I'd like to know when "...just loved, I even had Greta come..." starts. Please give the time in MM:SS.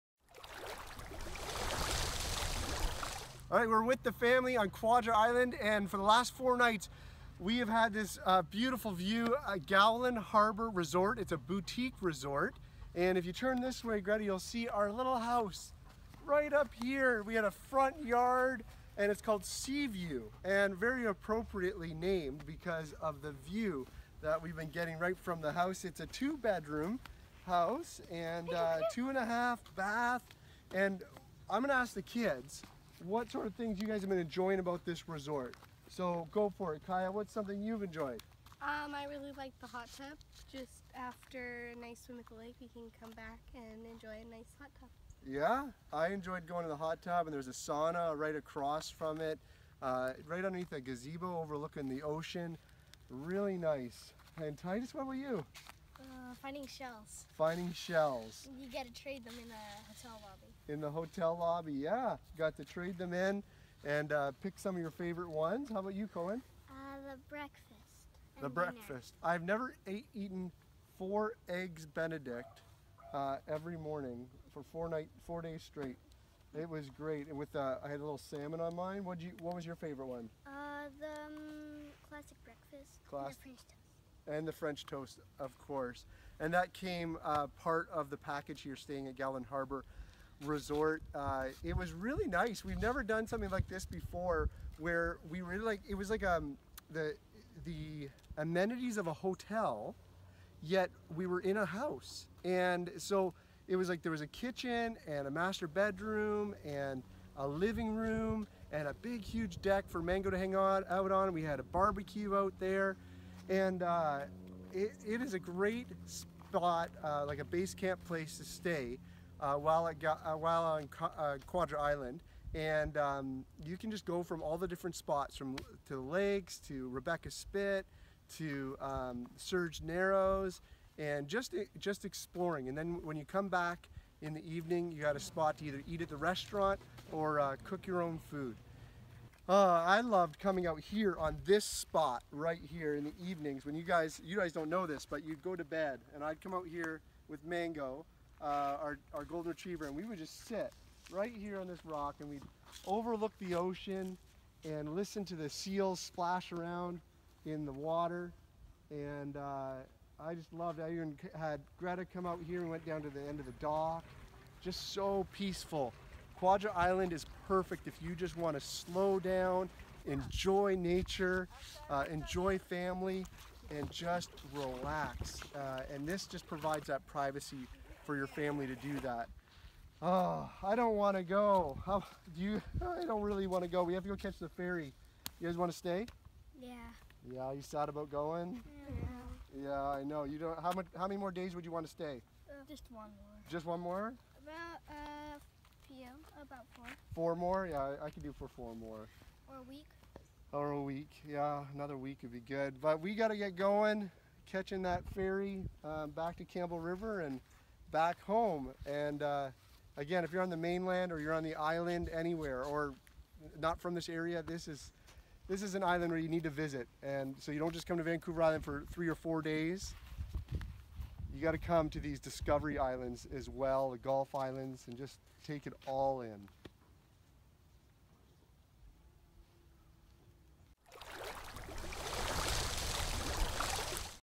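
02:40.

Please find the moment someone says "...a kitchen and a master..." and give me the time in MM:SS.
01:44.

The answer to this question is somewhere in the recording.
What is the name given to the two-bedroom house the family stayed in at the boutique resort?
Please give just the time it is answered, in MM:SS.
00:19.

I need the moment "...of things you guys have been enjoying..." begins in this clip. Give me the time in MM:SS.
00:33.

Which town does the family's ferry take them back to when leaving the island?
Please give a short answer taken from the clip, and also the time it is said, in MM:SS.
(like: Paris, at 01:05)
Campbell River, at 03:26.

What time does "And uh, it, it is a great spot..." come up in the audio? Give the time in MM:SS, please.
01:53.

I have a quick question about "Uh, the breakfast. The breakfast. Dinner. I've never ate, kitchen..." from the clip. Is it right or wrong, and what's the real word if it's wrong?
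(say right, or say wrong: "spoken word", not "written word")
wrong: "eaten", not "kitchen".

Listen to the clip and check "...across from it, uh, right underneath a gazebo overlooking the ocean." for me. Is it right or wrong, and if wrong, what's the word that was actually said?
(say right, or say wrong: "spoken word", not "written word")
right.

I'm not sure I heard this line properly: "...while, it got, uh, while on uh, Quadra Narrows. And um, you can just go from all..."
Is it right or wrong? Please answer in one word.
wrong.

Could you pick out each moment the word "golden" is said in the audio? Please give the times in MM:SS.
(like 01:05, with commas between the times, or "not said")
02:29.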